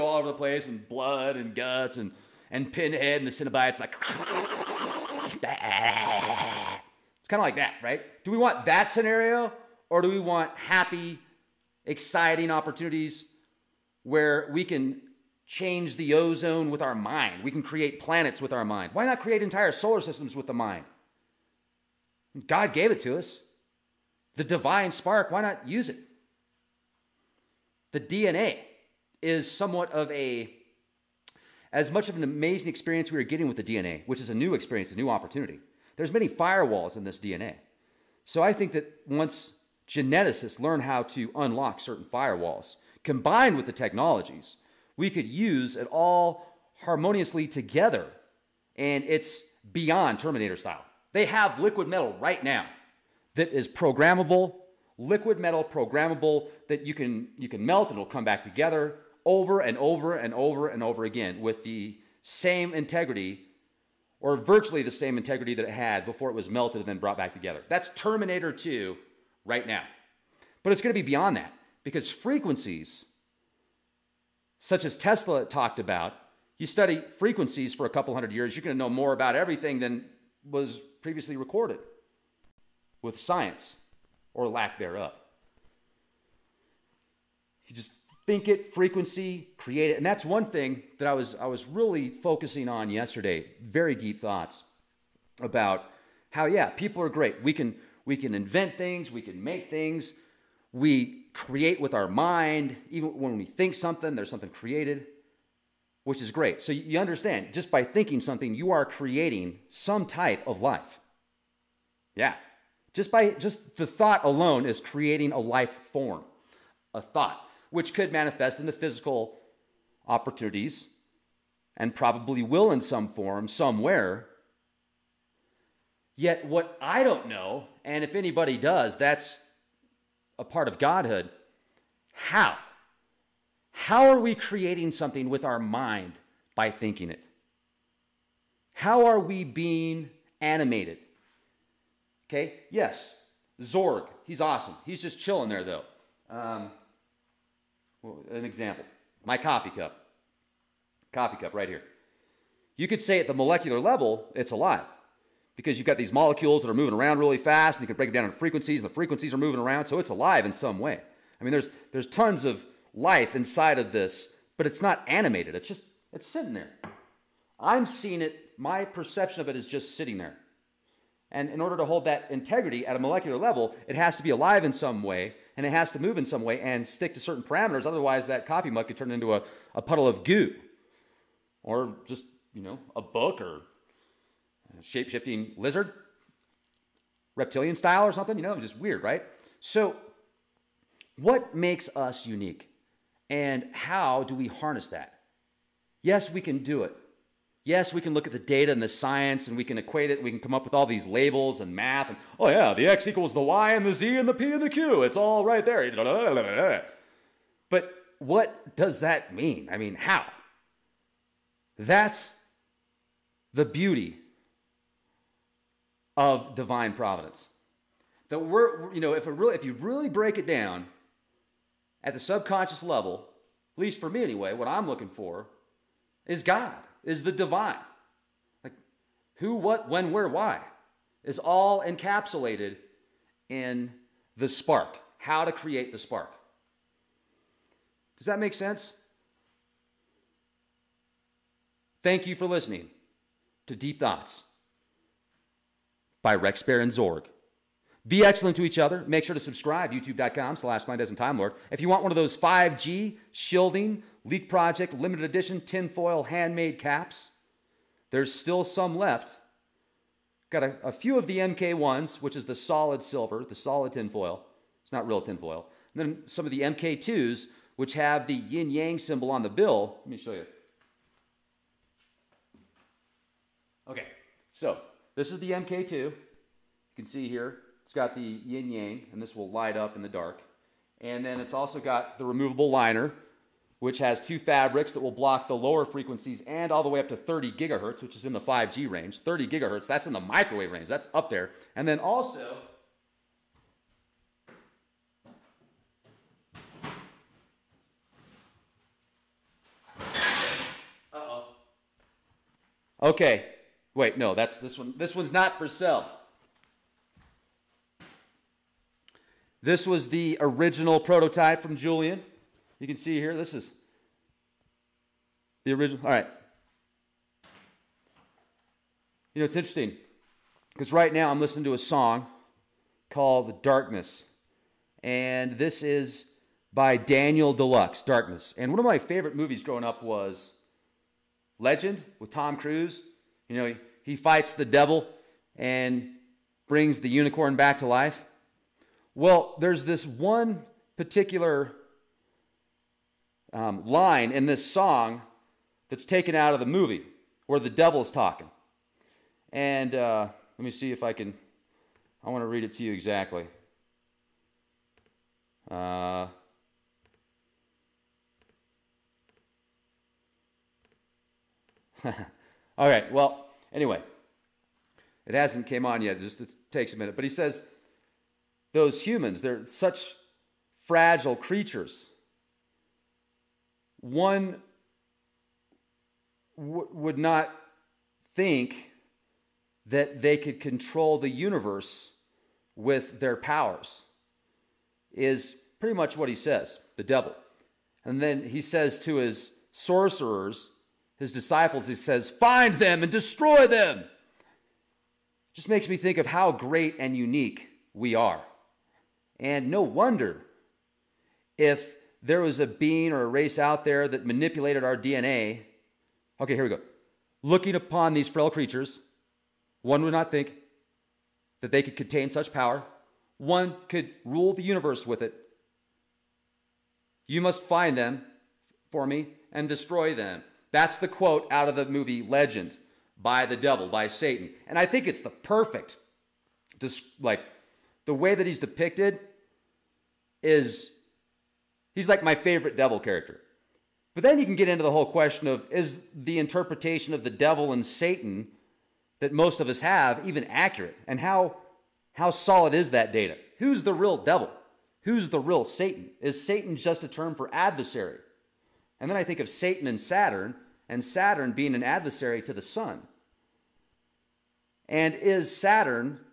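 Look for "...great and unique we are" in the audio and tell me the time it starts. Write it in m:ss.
6:36.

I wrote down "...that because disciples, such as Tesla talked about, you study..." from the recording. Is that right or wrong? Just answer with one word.
wrong.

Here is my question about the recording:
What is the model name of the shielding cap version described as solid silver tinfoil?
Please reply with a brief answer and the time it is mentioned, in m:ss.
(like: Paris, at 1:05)
MK1, at 4:21.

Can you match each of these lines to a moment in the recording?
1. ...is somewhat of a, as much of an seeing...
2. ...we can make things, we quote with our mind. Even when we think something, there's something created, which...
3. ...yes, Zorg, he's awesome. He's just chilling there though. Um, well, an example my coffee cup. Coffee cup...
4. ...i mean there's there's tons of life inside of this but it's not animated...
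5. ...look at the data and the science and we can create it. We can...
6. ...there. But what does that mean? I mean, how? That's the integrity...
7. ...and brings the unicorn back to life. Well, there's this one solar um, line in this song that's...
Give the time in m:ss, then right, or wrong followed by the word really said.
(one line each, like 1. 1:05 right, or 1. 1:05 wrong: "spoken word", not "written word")
1. 0:29 wrong: "amazing", not "seeing"
2. 1:39 wrong: "create", not "quote"
3. 2:22 right
4. 2:41 right
5. 3:18 wrong: "equate", not "create"
6. 3:25 wrong: "beauty", not "integrity"
7. 5:35 wrong: "particular", not "solar".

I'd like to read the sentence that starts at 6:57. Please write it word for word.
You must find them for me and destroy them.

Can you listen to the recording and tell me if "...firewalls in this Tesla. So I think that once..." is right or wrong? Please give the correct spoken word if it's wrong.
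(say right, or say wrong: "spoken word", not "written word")
wrong: "DNA", not "Tesla".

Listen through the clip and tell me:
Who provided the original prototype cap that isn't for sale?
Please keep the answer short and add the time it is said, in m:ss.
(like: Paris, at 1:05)
Julian, at 5:11.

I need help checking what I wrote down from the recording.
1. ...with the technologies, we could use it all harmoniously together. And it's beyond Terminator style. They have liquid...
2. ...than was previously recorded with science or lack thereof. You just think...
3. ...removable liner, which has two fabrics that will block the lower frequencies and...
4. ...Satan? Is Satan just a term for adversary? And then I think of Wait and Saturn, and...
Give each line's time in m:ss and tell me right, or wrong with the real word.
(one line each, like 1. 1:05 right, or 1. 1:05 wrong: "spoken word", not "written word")
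1. 0:43 right
2. 1:19 right
3. 4:42 right
4. 7:25 wrong: "Satan", not "Wait".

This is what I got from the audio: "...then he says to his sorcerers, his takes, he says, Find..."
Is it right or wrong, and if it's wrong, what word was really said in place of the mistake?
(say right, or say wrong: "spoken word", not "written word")
wrong: "disciples", not "takes".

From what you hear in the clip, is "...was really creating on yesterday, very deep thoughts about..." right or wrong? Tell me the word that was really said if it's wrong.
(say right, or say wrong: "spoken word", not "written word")
wrong: "focusing", not "creating".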